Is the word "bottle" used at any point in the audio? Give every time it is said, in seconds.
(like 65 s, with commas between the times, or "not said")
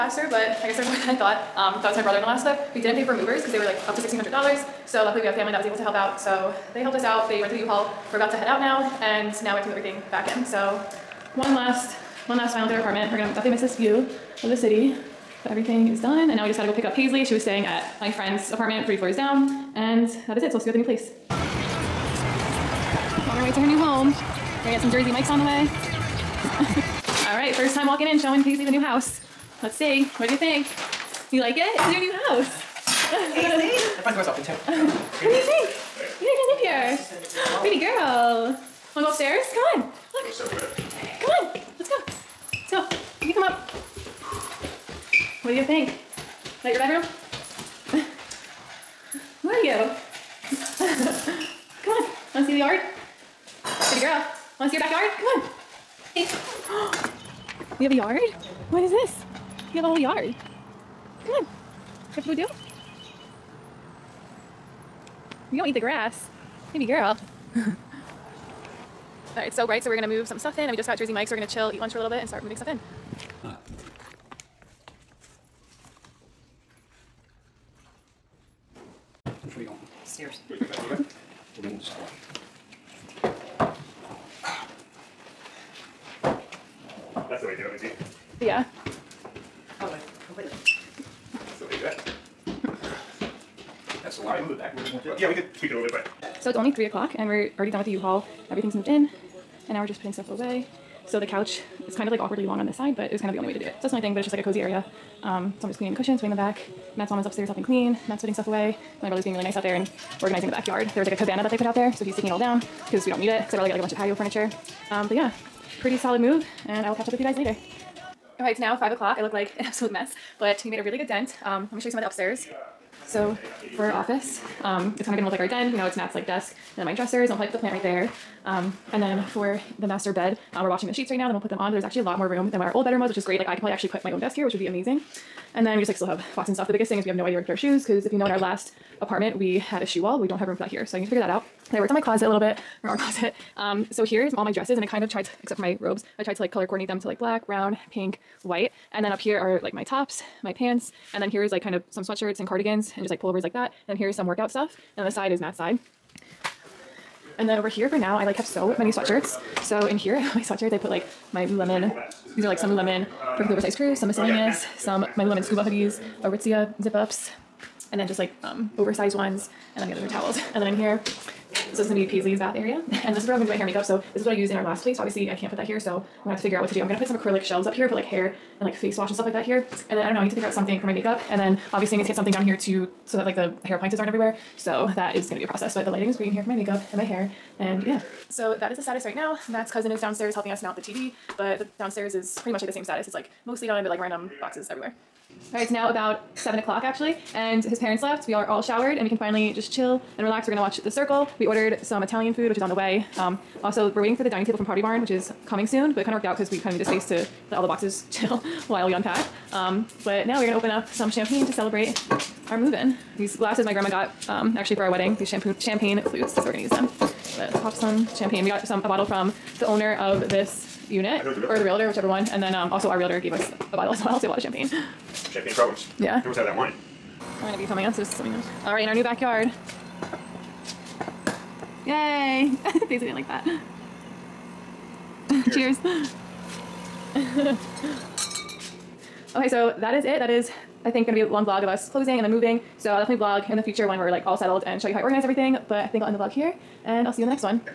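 218 s, 223 s.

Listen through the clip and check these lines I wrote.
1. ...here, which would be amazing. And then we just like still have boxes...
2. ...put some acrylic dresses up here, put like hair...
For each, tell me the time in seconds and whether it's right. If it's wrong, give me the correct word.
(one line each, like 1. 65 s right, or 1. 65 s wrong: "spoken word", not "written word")
1. 134 s right
2. 176 s wrong: "shelves", not "dresses".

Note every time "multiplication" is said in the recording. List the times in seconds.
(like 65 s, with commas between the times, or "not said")
not said.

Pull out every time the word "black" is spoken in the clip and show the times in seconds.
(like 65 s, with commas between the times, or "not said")
147 s.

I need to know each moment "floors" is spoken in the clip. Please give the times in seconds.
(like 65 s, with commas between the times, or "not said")
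18 s.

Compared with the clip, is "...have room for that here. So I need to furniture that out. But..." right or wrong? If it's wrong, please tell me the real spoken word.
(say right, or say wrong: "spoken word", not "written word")
wrong: "figure", not "furniture".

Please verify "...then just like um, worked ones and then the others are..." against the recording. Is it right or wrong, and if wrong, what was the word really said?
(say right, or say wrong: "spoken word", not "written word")
wrong: "oversized", not "worked".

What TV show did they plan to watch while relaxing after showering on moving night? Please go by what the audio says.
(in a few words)
The Circle.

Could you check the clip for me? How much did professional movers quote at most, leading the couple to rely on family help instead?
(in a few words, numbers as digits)
$1,600.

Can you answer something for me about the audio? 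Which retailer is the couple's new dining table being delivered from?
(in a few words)
Pottery Barn.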